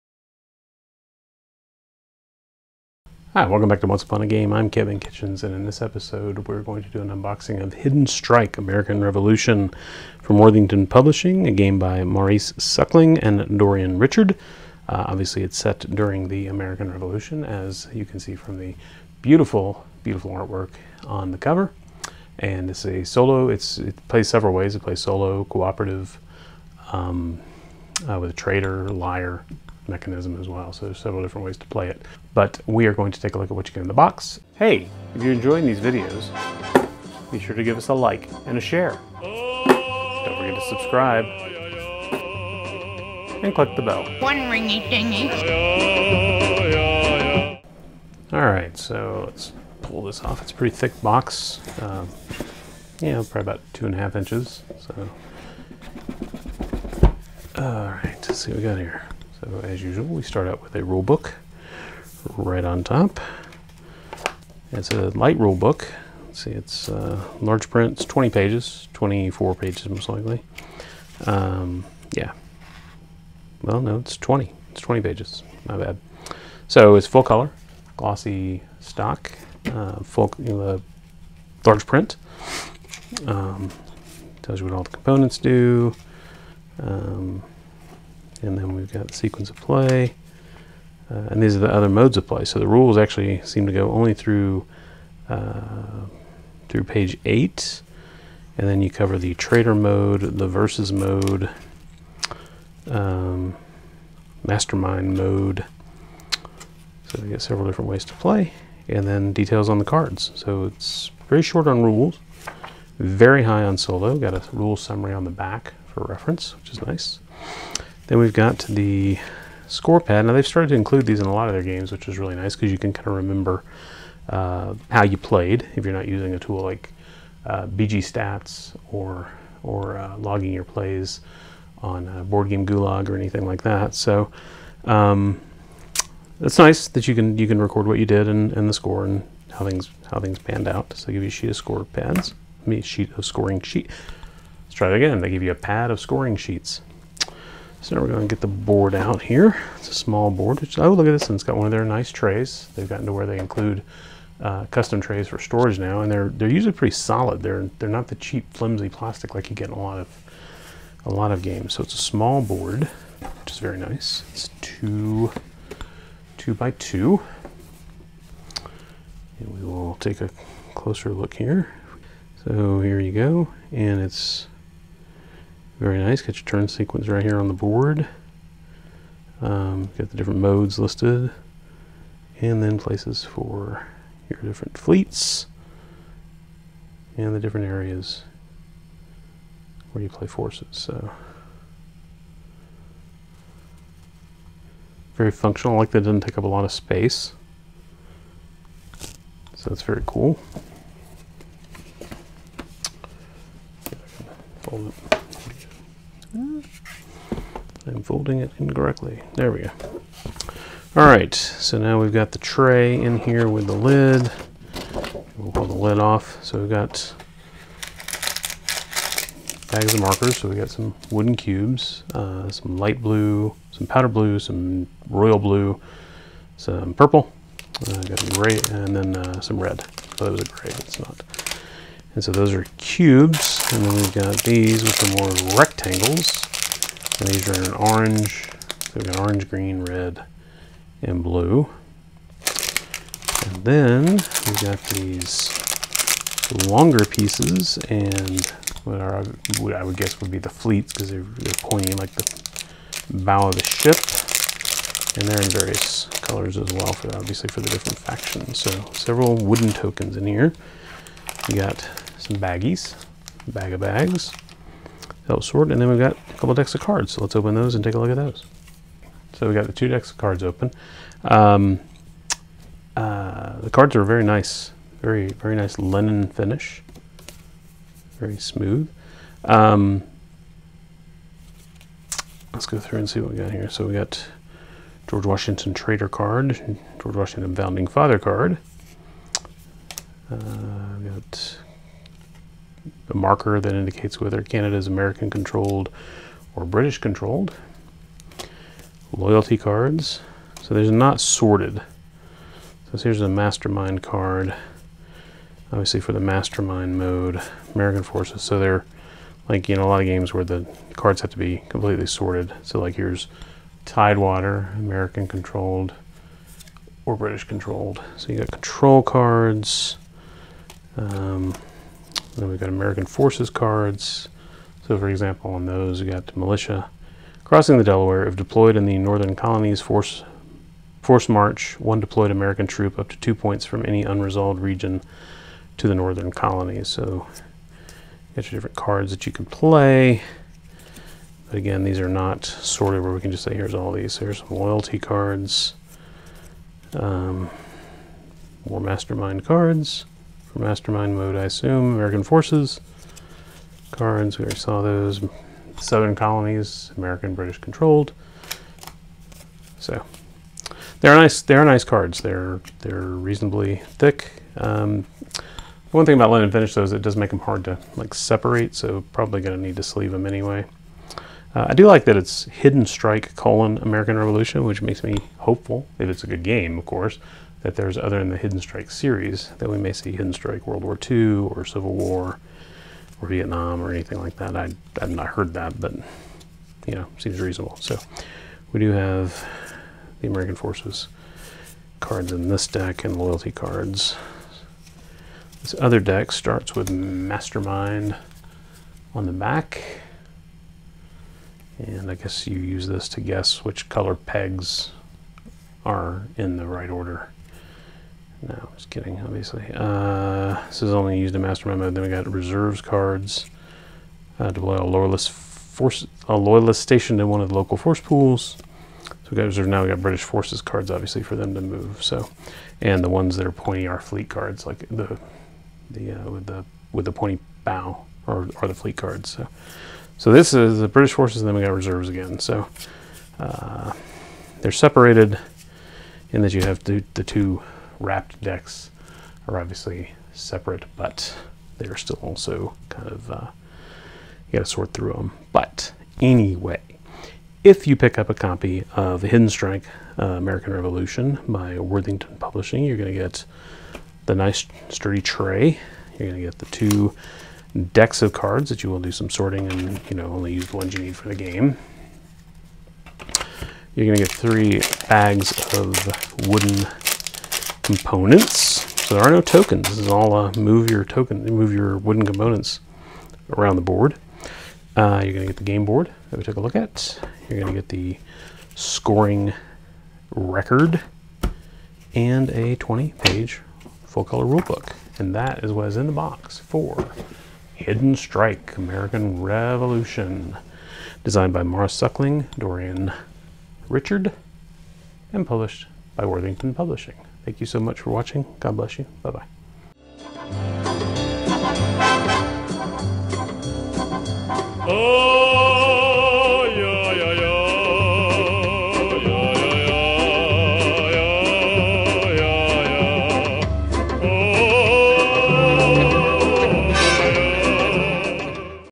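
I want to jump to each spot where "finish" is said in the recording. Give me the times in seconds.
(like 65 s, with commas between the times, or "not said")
276 s, 366 s.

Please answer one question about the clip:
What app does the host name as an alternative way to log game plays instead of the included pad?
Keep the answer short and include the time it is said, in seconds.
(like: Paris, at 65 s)
BG Stats, at 127 s.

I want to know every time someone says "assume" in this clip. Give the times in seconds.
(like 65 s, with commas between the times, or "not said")
351 s.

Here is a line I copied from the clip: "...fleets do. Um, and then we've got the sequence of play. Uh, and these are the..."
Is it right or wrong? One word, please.
wrong.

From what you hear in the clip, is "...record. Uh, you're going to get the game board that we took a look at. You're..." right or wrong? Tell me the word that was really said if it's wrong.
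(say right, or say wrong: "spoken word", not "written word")
wrong: "board", not "record".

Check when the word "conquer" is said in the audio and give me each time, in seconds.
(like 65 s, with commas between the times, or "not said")
not said.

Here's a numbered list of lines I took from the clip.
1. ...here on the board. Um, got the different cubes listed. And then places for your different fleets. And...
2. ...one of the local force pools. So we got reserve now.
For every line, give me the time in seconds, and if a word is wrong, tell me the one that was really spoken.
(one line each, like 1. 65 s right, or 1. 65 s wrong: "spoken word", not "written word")
1. 177 s wrong: "modes", not "cubes"
2. 417 s right.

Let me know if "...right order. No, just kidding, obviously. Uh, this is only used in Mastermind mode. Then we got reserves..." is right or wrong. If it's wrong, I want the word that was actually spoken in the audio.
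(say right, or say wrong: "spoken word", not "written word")
right.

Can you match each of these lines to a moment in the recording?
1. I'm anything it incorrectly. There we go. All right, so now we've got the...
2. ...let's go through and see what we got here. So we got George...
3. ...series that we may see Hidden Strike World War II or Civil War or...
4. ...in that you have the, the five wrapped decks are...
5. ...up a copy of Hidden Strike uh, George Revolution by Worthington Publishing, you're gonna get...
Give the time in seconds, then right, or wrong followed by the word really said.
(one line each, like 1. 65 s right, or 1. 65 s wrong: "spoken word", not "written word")
1. 207 s wrong: "folding", not "anything"
2. 282 s right
3. 378 s right
4. 436 s wrong: "two", not "five"
5. 448 s wrong: "American", not "George".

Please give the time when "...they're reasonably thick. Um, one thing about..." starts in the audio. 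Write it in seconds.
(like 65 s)
362 s.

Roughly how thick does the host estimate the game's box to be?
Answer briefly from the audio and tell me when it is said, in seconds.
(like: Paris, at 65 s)
2.5 inches, at 53 s.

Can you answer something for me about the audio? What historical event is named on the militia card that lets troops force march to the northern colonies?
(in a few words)
Crossing the Delaware.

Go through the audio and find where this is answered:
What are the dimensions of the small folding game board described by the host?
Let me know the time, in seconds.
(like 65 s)
164 s.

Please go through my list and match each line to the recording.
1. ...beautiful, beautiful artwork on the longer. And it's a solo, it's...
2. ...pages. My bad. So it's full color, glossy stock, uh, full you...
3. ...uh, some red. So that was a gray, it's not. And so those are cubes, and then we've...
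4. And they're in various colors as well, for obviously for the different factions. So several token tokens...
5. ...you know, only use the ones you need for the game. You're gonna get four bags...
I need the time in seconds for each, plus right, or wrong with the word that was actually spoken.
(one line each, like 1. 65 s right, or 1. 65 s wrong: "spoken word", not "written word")
1. 19 s wrong: "cover", not "longer"
2. 75 s right
3. 229 s right
4. 255 s wrong: "wooden", not "token"
5. 460 s wrong: "three", not "four".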